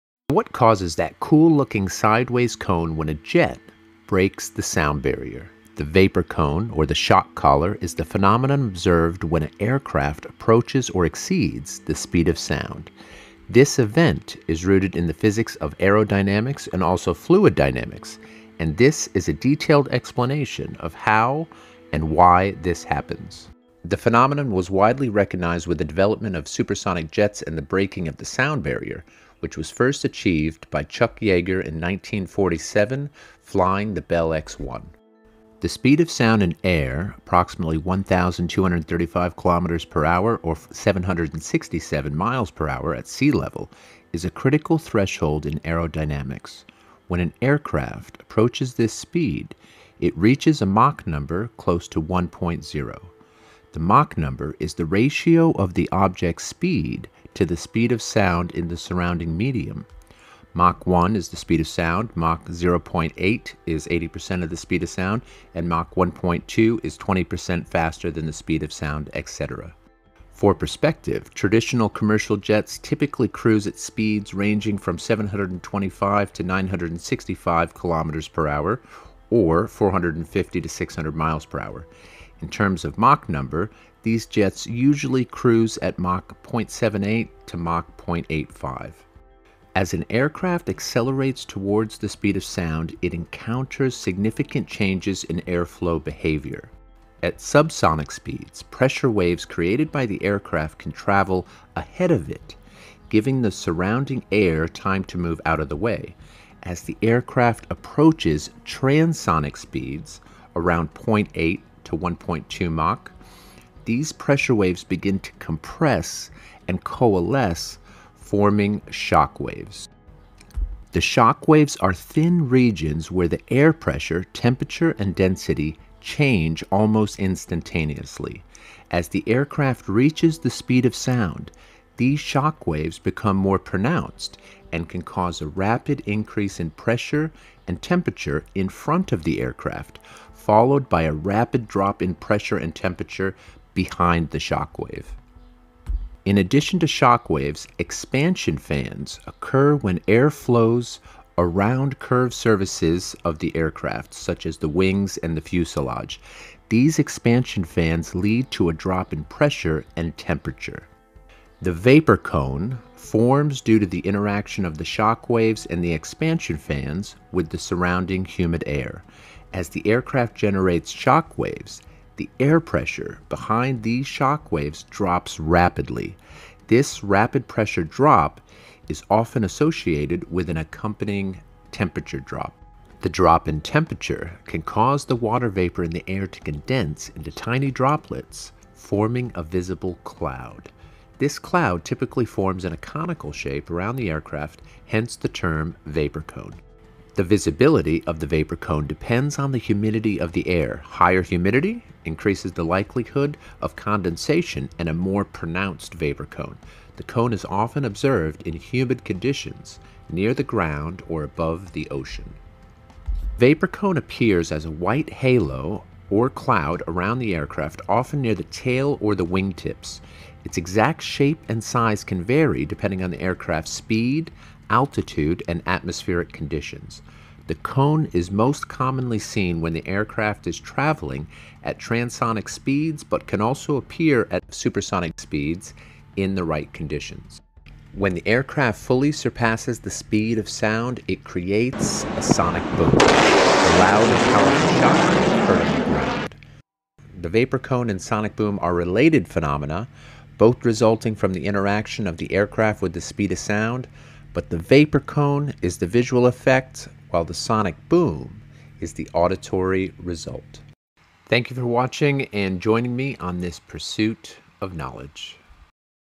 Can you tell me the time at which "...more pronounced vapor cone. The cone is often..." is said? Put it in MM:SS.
03:24.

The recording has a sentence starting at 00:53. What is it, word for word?
The Mach number is the ratio of the object's speed to the speed of sound in the surrounding medium.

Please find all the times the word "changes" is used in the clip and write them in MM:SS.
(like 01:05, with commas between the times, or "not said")
01:34, 02:06.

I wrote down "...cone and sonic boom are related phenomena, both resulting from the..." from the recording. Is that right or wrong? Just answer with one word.
right.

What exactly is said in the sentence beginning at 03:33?
Vapor cone appears as a white halo or cloud around the aircraft, often near the tail or the wingtips.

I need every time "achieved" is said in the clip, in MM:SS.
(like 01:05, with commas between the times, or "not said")
00:30.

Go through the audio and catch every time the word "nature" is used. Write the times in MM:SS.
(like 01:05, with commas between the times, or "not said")
not said.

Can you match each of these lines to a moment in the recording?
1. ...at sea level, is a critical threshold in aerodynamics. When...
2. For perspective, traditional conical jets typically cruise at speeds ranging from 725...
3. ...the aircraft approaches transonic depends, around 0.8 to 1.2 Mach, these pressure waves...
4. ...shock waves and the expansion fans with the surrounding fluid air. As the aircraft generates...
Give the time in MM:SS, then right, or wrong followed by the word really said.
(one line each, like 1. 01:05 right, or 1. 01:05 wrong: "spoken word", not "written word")
1. 00:42 right
2. 01:10 wrong: "commercial", not "conical"
3. 01:46 wrong: "speeds", not "depends"
4. 02:44 wrong: "humid", not "fluid".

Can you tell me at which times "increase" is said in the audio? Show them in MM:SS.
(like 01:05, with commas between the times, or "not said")
02:16, 03:22.